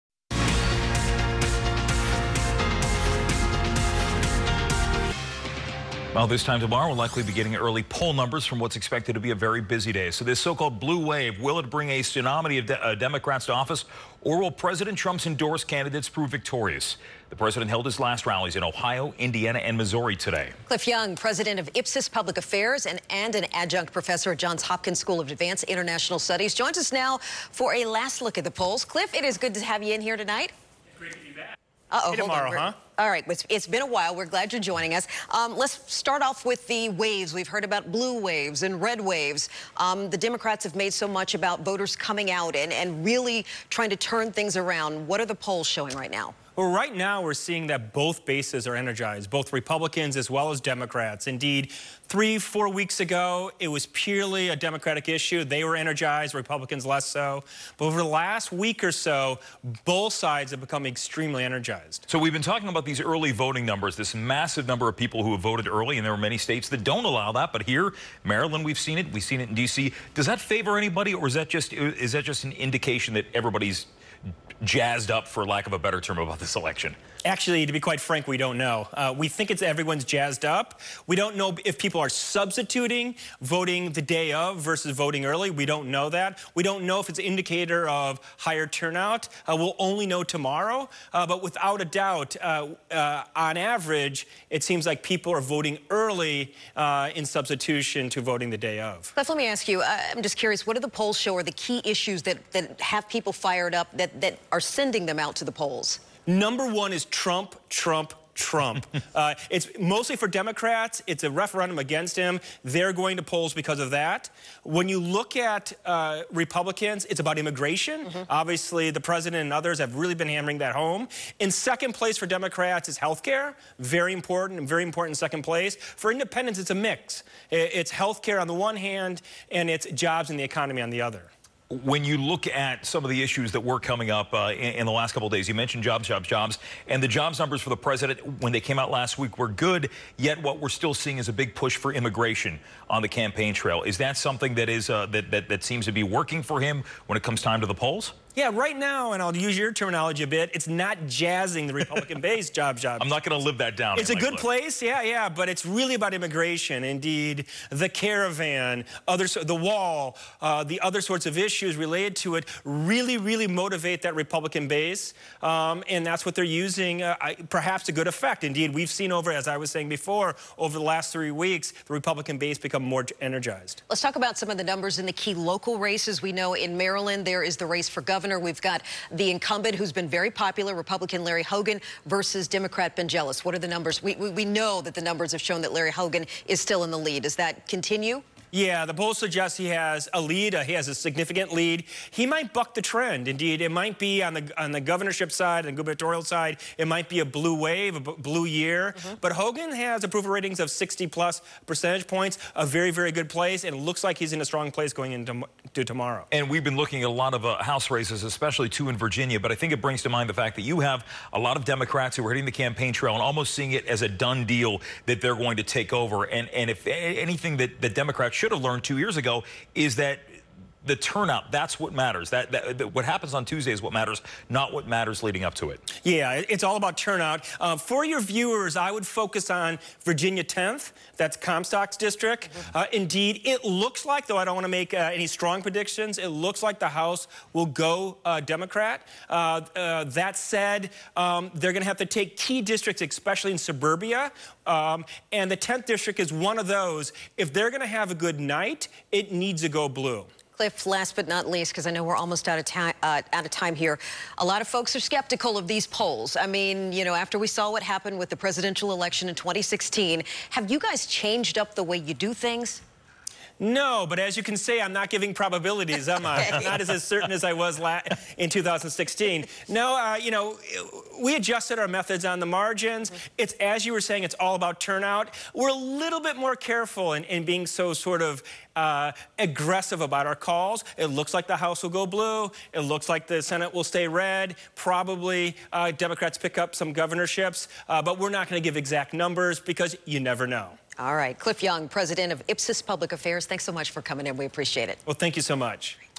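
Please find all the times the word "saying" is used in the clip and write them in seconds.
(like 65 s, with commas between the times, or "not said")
169 s, 274 s.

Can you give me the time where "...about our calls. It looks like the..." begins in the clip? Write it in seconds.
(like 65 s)
280 s.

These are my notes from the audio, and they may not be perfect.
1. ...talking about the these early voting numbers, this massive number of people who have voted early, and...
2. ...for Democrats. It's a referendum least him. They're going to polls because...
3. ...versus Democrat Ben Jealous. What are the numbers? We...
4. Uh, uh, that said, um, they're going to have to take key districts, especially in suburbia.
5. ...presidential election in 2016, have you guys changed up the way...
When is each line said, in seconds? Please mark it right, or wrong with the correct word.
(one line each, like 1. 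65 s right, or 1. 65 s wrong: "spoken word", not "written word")
1. 62 s right
2. 110 s wrong: "against", not "least"
3. 182 s right
4. 239 s right
5. 258 s right.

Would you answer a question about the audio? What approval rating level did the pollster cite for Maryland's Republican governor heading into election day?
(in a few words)
60 plus percent.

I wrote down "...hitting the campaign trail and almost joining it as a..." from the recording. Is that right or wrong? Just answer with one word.
wrong.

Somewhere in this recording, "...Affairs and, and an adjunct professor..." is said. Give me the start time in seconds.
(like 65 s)
22 s.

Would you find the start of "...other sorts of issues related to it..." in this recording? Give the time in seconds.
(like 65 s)
160 s.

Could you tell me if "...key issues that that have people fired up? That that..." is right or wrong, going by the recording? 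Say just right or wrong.
right.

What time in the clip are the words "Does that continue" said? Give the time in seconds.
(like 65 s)
187 s.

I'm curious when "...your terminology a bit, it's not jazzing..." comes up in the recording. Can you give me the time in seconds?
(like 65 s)
149 s.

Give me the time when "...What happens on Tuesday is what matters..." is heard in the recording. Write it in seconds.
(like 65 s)
222 s.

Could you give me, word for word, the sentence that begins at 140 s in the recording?
Yet, what we're still seeing is a big push for immigration on the campaign trail.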